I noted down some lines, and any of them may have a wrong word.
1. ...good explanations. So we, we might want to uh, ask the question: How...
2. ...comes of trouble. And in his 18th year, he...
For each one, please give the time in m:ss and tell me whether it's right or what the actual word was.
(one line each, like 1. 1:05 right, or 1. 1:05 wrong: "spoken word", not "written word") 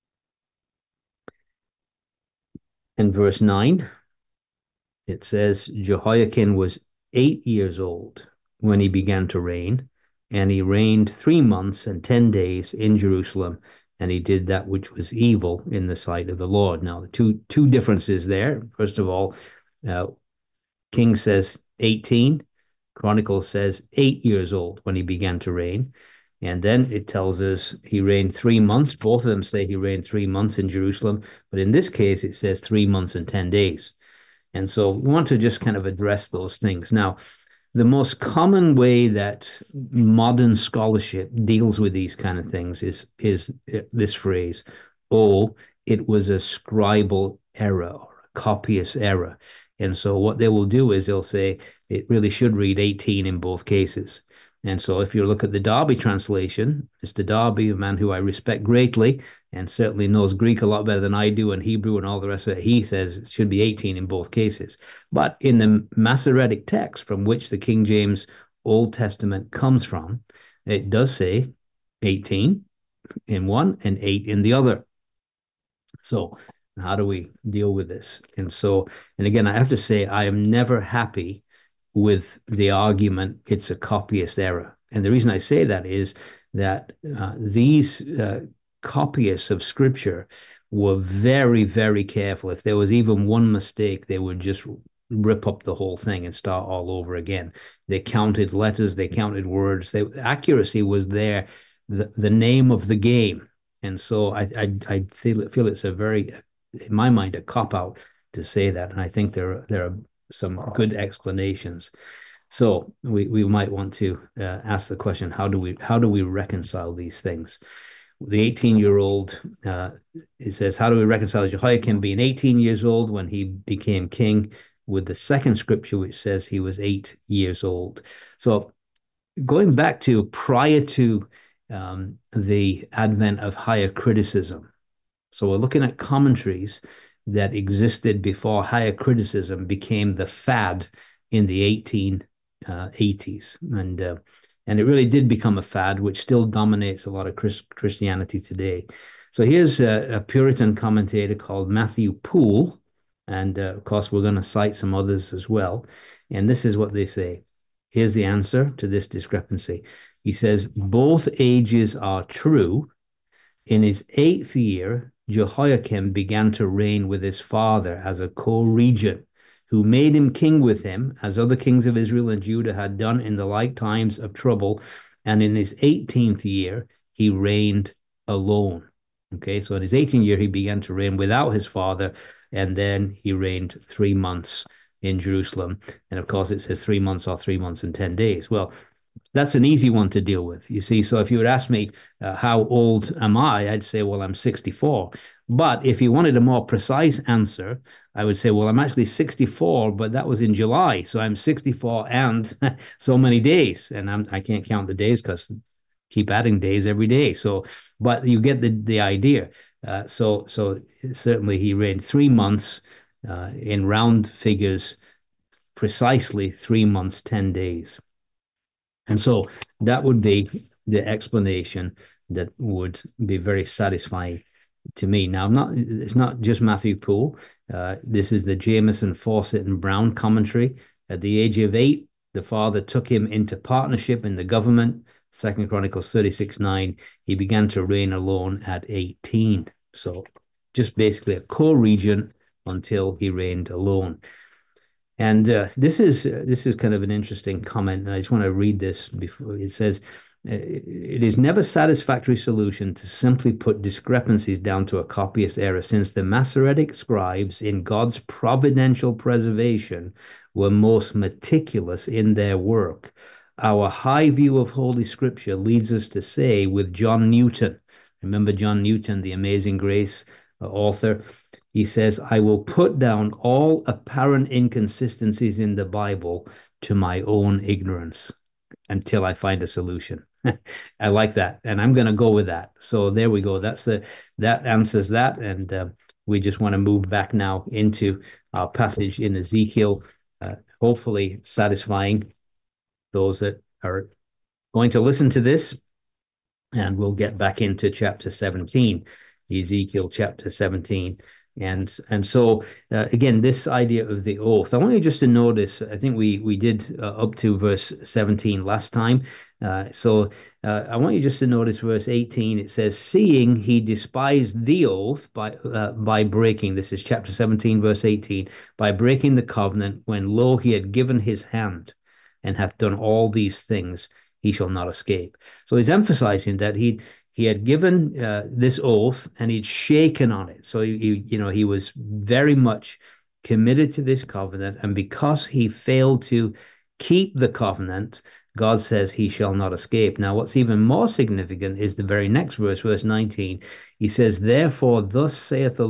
1. 1:50 right
2. 2:53 wrong: "times", not "comes".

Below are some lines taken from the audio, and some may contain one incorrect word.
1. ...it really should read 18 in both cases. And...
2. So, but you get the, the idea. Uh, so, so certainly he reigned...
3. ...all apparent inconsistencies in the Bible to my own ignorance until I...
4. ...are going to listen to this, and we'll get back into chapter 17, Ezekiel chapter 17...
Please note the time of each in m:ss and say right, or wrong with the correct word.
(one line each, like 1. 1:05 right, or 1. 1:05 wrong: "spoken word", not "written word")
1. 0:51 right
2. 3:27 right
3. 4:33 right
4. 4:53 right.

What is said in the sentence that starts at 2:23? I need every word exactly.
Uh, and uh, and it really did become a fad, which still dominates a lot of Chris- Christianity today.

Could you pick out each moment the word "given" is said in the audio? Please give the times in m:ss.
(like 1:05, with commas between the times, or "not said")
5:20, 5:27.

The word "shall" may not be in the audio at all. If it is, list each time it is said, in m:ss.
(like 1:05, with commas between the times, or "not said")
5:24, 5:39.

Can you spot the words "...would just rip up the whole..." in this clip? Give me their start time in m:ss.
1:34.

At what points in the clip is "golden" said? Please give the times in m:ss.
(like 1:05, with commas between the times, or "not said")
not said.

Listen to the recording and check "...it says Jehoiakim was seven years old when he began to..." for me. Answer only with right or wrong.
wrong.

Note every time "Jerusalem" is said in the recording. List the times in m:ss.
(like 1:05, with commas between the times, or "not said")
0:12, 0:30, 3:05.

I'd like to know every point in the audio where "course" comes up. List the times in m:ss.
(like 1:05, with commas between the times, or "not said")
2:33, 3:06.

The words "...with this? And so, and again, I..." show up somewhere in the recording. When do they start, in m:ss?
1:17.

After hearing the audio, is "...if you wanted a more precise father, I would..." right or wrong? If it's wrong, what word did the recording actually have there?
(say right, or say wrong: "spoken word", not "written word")
wrong: "answer", not "father".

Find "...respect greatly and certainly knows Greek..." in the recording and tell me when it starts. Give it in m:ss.
0:58.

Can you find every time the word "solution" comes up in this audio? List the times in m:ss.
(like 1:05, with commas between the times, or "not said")
4:12, 4:39.